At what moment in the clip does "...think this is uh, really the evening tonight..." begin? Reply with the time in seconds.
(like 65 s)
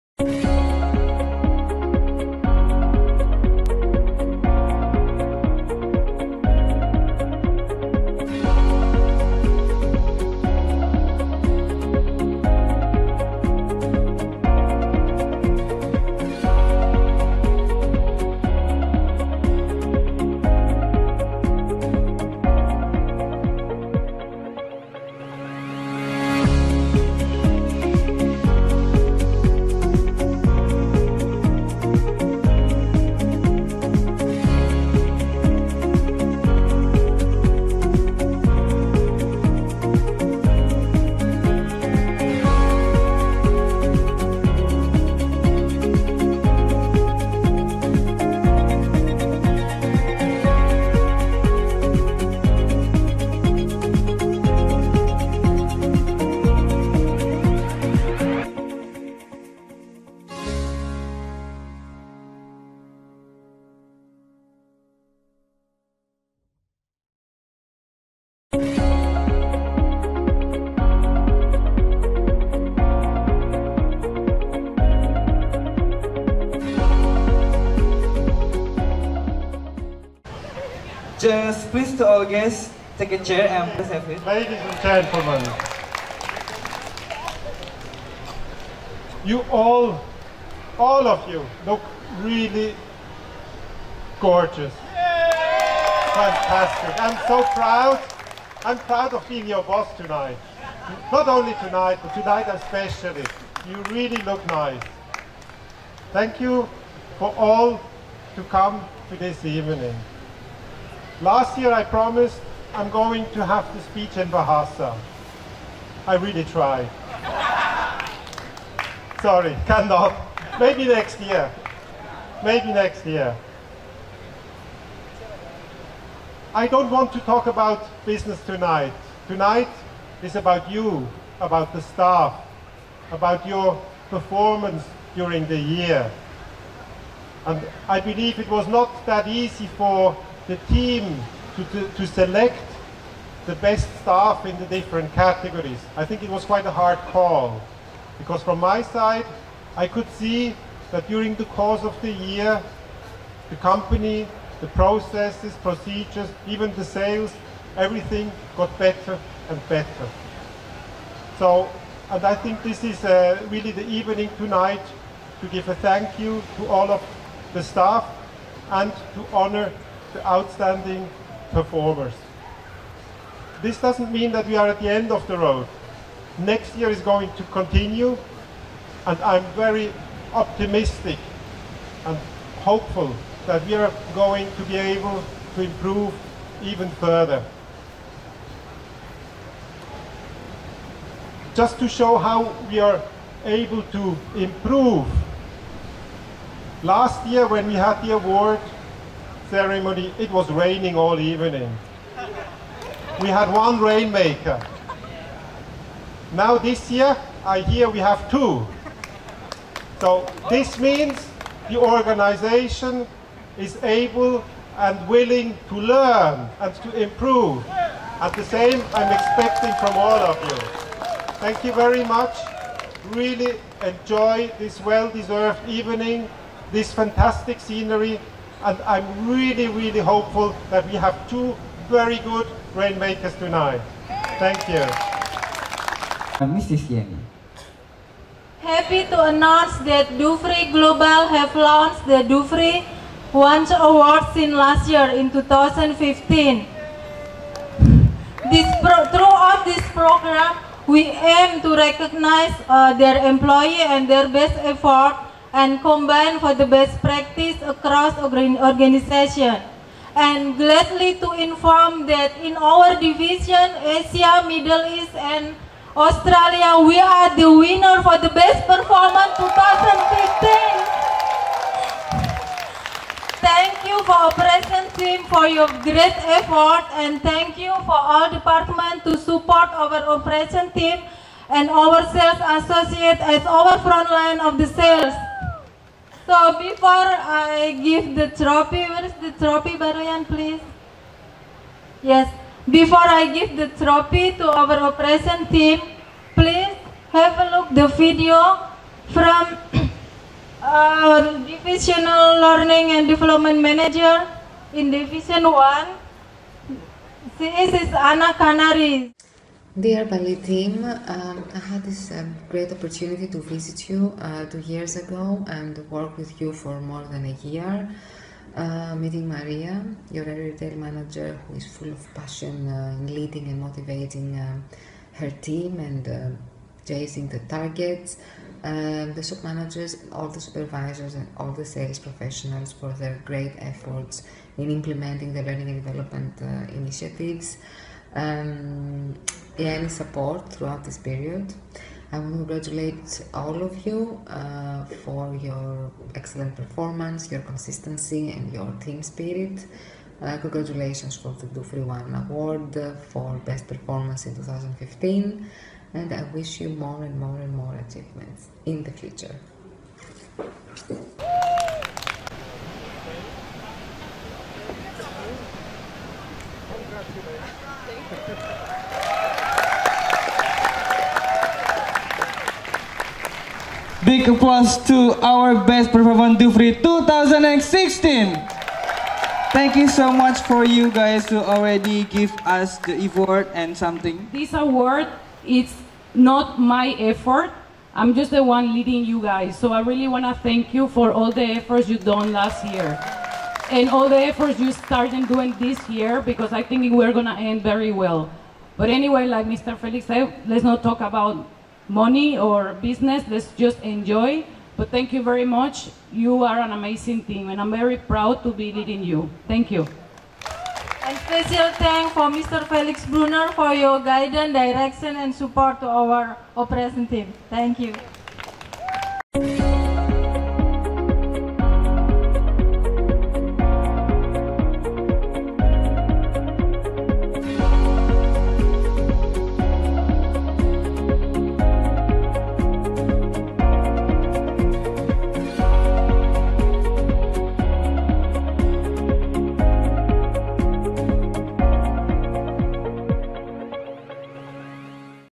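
162 s.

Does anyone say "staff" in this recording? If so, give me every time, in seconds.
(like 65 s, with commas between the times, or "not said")
131 s, 144 s, 167 s.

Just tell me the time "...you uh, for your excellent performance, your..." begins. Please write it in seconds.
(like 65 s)
343 s.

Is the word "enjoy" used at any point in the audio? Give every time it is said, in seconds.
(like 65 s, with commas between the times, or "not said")
223 s, 403 s.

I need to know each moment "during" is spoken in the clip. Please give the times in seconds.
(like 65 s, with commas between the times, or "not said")
135 s, 151 s.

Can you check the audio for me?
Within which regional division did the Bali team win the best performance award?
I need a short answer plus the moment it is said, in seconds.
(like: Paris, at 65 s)
Asia, Middle East, and Australia, at 263 s.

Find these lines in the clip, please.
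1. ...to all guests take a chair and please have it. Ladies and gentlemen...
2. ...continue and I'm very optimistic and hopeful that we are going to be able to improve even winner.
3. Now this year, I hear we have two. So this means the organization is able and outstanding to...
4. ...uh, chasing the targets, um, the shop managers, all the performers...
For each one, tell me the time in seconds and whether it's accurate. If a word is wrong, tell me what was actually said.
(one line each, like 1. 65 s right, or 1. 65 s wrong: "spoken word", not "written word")
1. 81 s right
2. 177 s wrong: "further", not "winner"
3. 206 s wrong: "willing", not "outstanding"
4. 326 s wrong: "supervisors", not "performers".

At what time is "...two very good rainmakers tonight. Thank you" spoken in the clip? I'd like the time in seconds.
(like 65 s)
231 s.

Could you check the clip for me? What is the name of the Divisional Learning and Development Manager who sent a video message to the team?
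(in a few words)
Anna Canaries.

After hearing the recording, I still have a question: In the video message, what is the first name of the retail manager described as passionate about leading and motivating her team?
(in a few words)
Maria.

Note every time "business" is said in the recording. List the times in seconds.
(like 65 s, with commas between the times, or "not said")
128 s, 402 s.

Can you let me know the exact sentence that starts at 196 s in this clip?
Last year when we had the award ceremony, it was raining all evening.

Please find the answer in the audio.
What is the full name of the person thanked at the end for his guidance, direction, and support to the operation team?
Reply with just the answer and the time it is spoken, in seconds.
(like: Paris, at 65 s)
Felix Brunner, at 412 s.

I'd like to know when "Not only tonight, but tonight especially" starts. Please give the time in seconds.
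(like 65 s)
101 s.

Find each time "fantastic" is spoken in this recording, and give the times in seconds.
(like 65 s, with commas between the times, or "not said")
96 s, 226 s.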